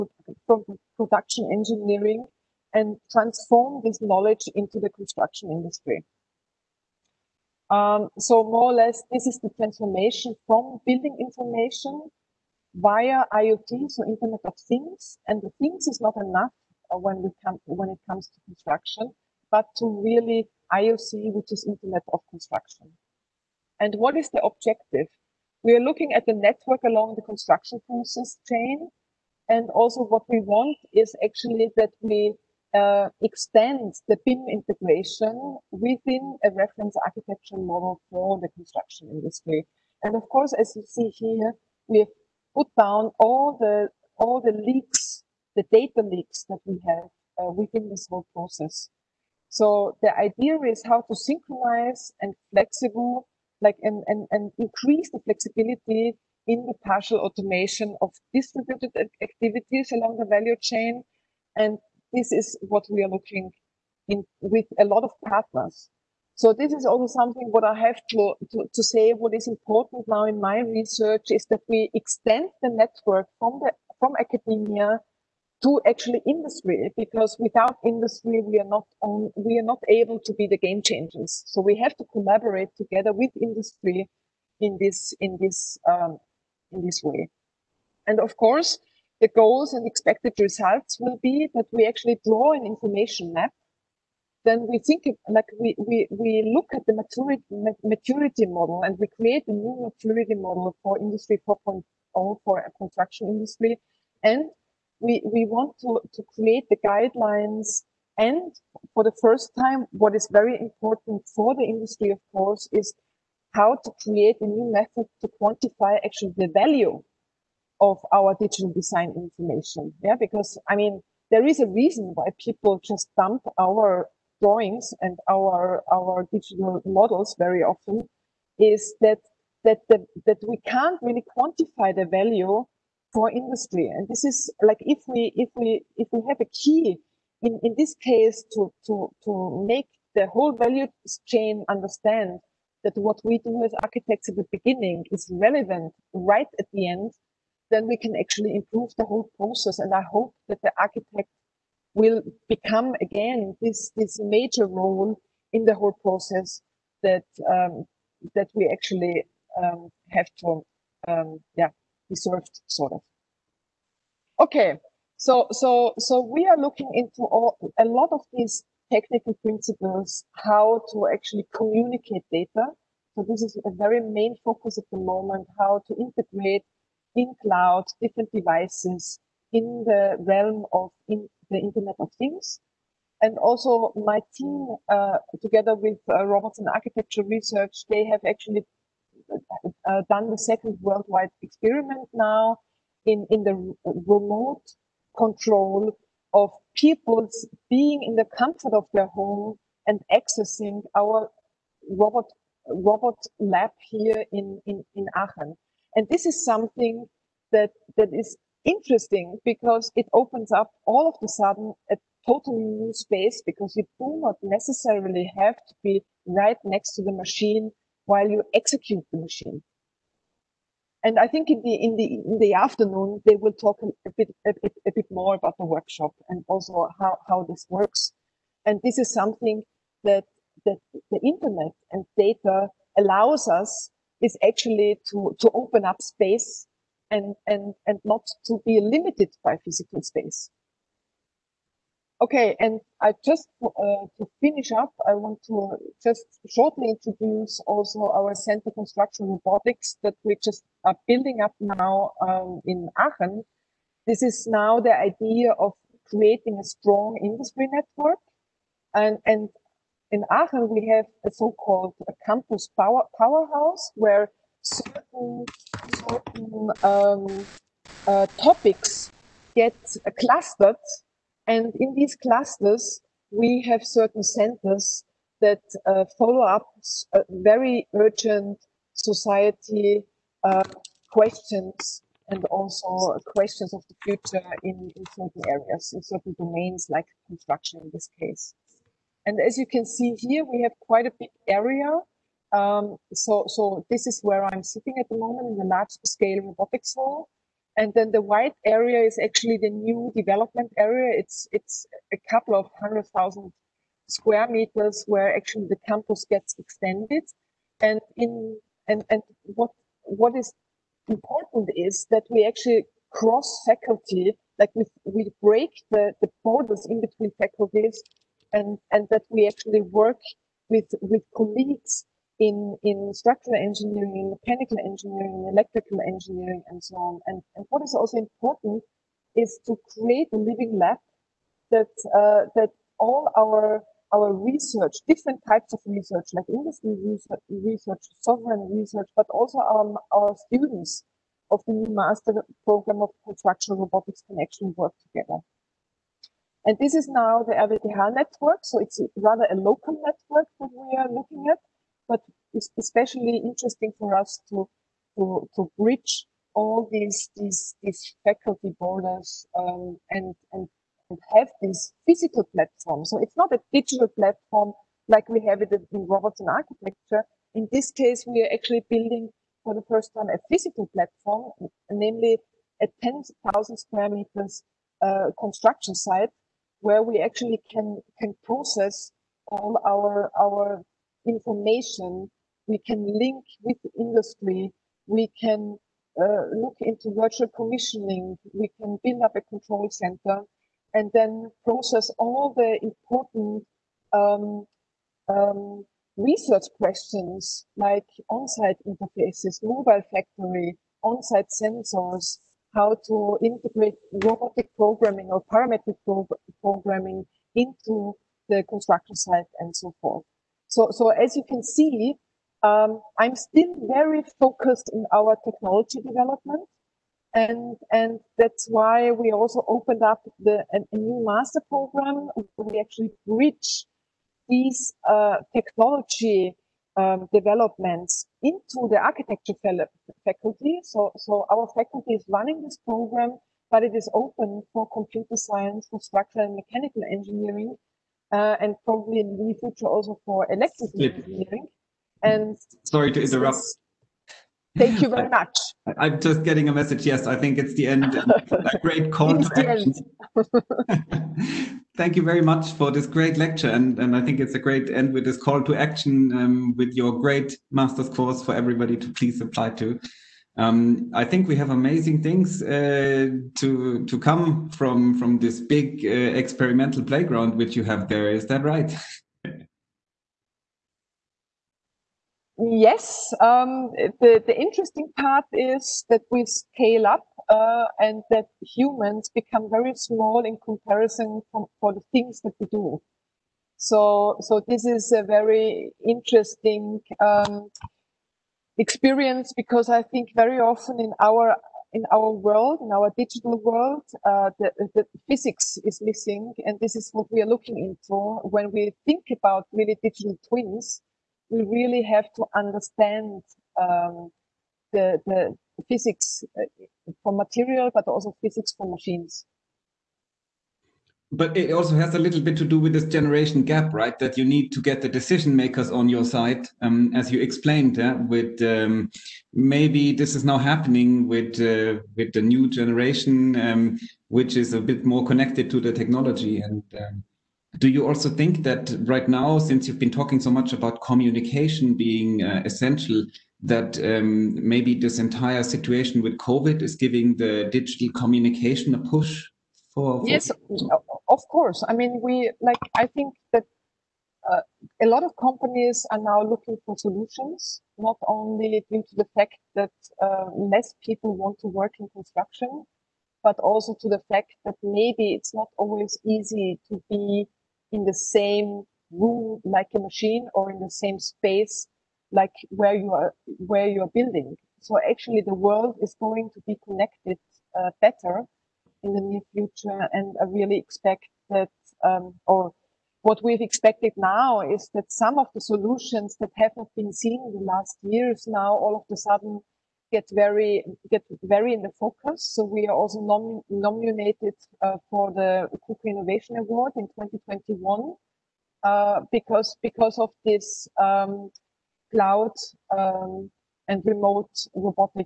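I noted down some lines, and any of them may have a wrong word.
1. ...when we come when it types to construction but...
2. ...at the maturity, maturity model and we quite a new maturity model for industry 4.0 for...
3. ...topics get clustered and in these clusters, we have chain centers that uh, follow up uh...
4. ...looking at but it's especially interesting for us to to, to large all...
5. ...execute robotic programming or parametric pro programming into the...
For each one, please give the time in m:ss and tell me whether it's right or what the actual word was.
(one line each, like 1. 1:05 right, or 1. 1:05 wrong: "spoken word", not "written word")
1. 0:16 wrong: "comes", not "types"
2. 1:36 wrong: "create", not "quite"
3. 4:28 wrong: "certain", not "chain"
4. 5:51 wrong: "bridge", not "large"
5. 6:43 wrong: "integrate", not "execute".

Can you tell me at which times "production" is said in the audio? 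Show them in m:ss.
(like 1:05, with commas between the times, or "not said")
0:00.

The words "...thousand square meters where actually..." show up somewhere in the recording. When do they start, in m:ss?
5:03.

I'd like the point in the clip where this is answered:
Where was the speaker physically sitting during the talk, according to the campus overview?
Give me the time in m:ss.
4:55.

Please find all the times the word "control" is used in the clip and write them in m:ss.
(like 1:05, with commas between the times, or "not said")
3:15, 6:29.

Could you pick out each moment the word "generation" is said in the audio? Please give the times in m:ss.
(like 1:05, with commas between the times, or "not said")
8:33, 8:42.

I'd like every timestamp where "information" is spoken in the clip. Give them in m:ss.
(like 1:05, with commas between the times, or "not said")
0:11, 1:32, 1:59, 6:21.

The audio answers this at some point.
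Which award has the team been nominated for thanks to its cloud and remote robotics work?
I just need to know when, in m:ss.
9:45.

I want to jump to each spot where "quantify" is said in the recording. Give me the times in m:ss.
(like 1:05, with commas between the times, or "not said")
1:55, 2:11.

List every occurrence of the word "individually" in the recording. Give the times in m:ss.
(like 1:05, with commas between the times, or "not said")
not said.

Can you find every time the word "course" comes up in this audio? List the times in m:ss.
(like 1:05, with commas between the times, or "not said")
0:40, 1:28, 1:52, 7:38, 9:01.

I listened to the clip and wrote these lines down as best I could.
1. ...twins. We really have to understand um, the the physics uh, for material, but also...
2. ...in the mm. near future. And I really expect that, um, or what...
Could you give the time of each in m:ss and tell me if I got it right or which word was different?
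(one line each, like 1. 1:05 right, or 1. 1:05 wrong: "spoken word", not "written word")
1. 8:20 right
2. 9:29 right.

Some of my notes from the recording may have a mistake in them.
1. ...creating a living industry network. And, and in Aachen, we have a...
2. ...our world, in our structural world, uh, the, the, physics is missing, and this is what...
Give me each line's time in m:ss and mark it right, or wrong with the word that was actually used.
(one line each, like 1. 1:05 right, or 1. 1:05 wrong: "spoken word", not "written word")
1. 4:16 wrong: "strong", not "living"
2. 8:12 wrong: "digital", not "structural".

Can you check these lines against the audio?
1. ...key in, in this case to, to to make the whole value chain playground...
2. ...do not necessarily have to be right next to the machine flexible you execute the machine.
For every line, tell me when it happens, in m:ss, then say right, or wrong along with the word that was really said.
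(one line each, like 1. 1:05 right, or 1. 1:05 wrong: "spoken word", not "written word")
1. 2:16 wrong: "understand", not "playground"
2. 3:33 wrong: "while", not "flexible".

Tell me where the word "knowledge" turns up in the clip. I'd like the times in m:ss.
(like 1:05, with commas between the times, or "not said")
0:04.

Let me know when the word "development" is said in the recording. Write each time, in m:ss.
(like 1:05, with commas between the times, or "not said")
5:00, 6:56, 7:07.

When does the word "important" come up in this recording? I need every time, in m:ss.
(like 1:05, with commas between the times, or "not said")
1:09, 1:50, 5:11, 5:28, 6:32.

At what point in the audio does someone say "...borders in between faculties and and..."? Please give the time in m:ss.
5:16.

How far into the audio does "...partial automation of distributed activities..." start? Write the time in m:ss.
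0:56.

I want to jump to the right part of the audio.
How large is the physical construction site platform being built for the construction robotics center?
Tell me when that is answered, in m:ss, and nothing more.
6:13.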